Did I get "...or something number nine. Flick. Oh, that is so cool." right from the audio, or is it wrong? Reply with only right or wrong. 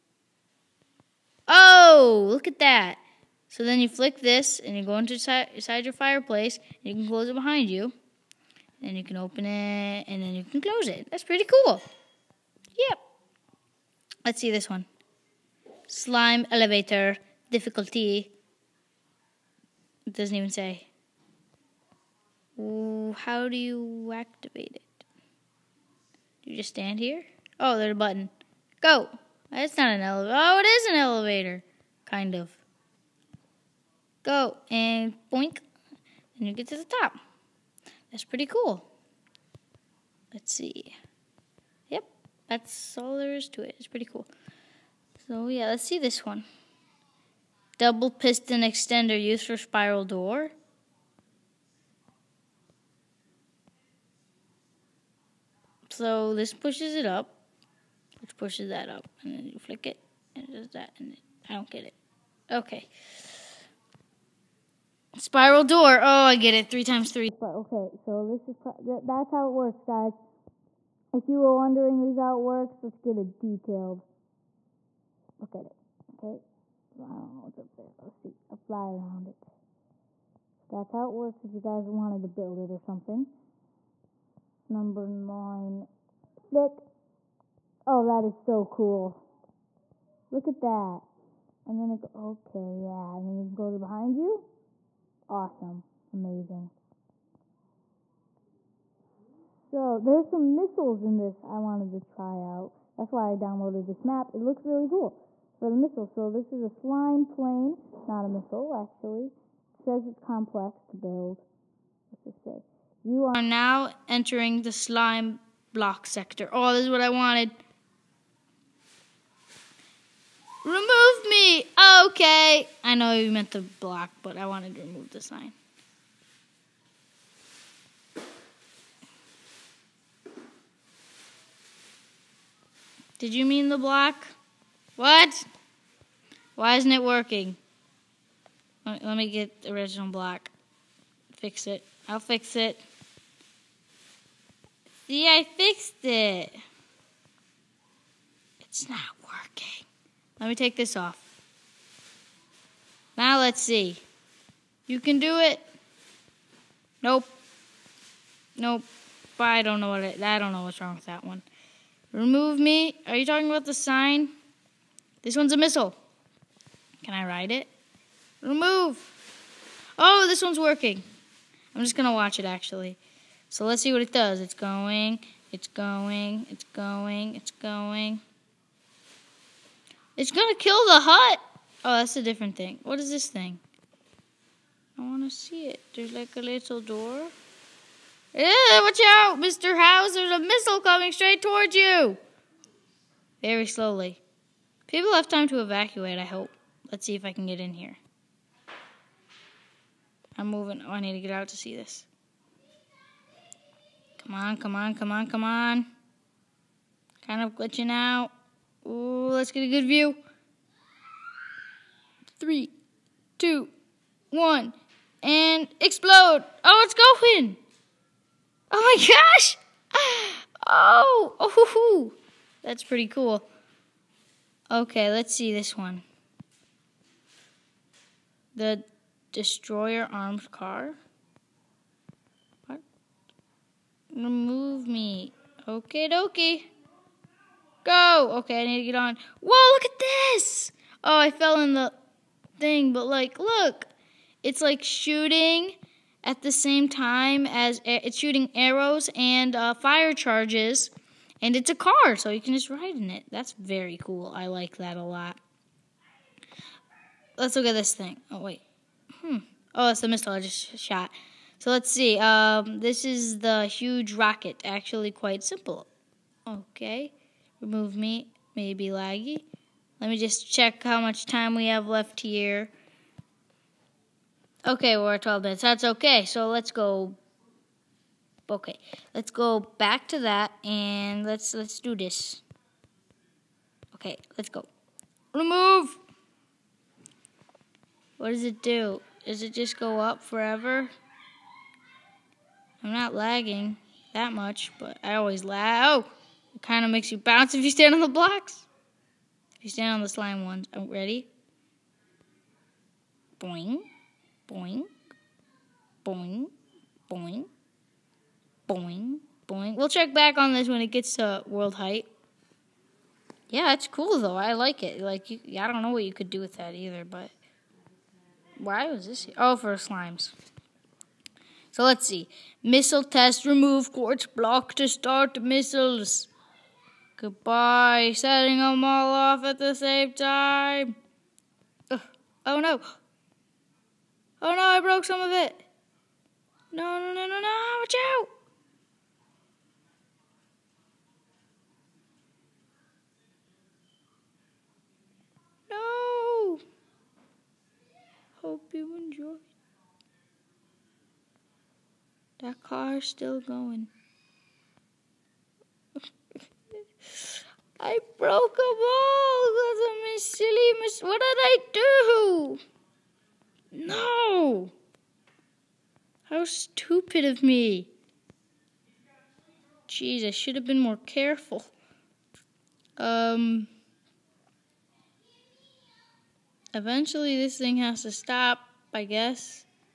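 right.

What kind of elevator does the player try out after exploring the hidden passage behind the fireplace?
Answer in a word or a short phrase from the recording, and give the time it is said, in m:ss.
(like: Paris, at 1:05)
Slime elevator, at 0:15.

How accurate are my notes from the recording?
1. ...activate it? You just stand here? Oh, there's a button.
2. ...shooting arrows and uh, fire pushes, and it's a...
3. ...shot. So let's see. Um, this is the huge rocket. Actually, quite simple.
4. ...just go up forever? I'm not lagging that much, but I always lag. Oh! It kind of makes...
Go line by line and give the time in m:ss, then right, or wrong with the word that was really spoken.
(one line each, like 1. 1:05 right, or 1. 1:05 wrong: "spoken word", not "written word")
1. 0:24 right
2. 4:08 wrong: "charges", not "pushes"
3. 4:20 right
4. 4:49 right.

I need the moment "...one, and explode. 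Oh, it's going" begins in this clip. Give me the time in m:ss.
3:34.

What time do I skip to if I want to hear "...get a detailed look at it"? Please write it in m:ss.
1:12.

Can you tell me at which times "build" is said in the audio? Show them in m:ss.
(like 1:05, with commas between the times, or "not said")
1:22, 1:50.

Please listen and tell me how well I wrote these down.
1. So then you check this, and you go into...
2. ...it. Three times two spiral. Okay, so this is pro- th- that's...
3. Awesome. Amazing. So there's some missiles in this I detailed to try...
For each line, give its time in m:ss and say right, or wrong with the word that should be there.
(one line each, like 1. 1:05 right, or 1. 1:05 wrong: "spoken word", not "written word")
1. 0:03 wrong: "flick", not "check"
2. 1:06 wrong: "three", not "two"
3. 1:35 wrong: "wanted", not "detailed".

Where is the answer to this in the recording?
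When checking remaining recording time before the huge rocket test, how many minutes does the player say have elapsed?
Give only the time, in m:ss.
4:35.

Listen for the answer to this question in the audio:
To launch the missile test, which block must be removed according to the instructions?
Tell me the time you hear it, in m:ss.
5:23.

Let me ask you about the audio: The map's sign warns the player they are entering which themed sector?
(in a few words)
Slime block sector.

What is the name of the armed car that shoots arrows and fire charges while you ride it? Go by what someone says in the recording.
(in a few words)
The Destroyer.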